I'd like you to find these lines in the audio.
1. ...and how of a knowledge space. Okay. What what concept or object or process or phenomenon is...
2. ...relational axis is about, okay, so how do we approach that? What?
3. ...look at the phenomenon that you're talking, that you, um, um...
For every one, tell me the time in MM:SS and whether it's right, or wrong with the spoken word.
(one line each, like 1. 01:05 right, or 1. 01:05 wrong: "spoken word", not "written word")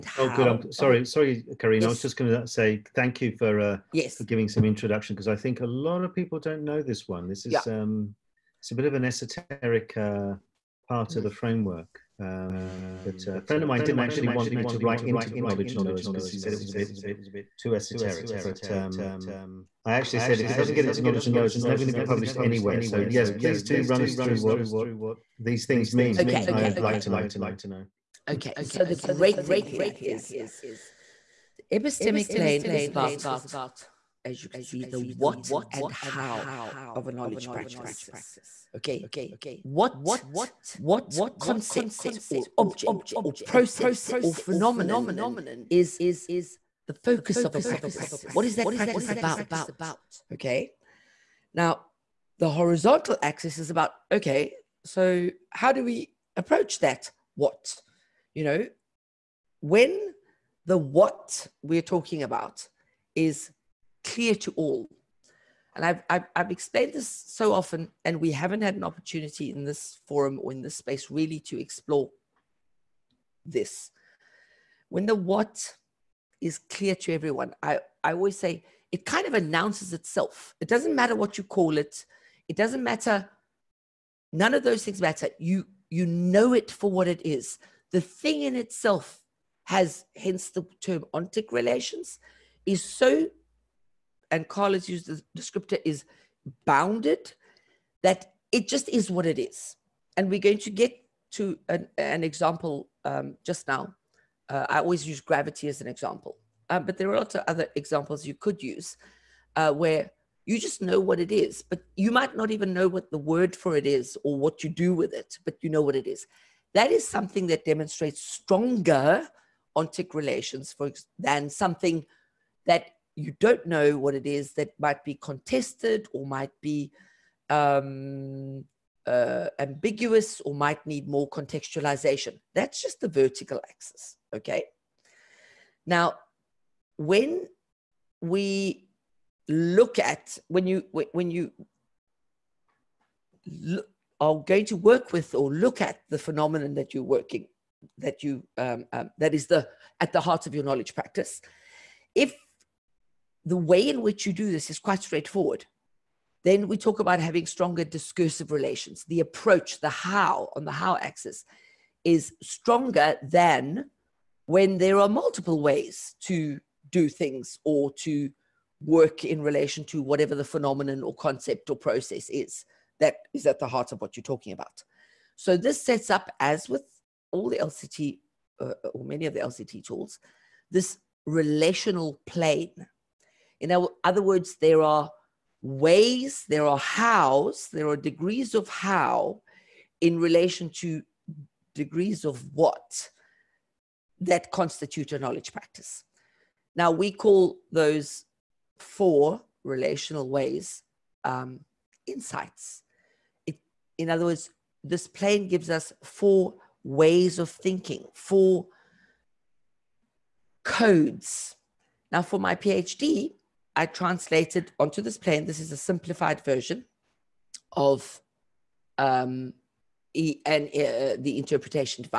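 1. 00:35 wrong: "practice", not "space"
2. 00:52 wrong: "horizontal", not "relational"
3. 02:25 wrong: "working", not "talking".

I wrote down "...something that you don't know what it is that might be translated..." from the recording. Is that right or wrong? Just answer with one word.
wrong.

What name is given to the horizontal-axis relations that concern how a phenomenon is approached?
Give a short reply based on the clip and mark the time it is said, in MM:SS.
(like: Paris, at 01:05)
Discursive relations, at 02:37.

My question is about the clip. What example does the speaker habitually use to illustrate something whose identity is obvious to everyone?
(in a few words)
Gravity.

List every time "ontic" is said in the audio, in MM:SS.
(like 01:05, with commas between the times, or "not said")
01:31, 01:59.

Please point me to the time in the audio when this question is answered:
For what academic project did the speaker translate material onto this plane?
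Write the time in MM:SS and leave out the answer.
03:32.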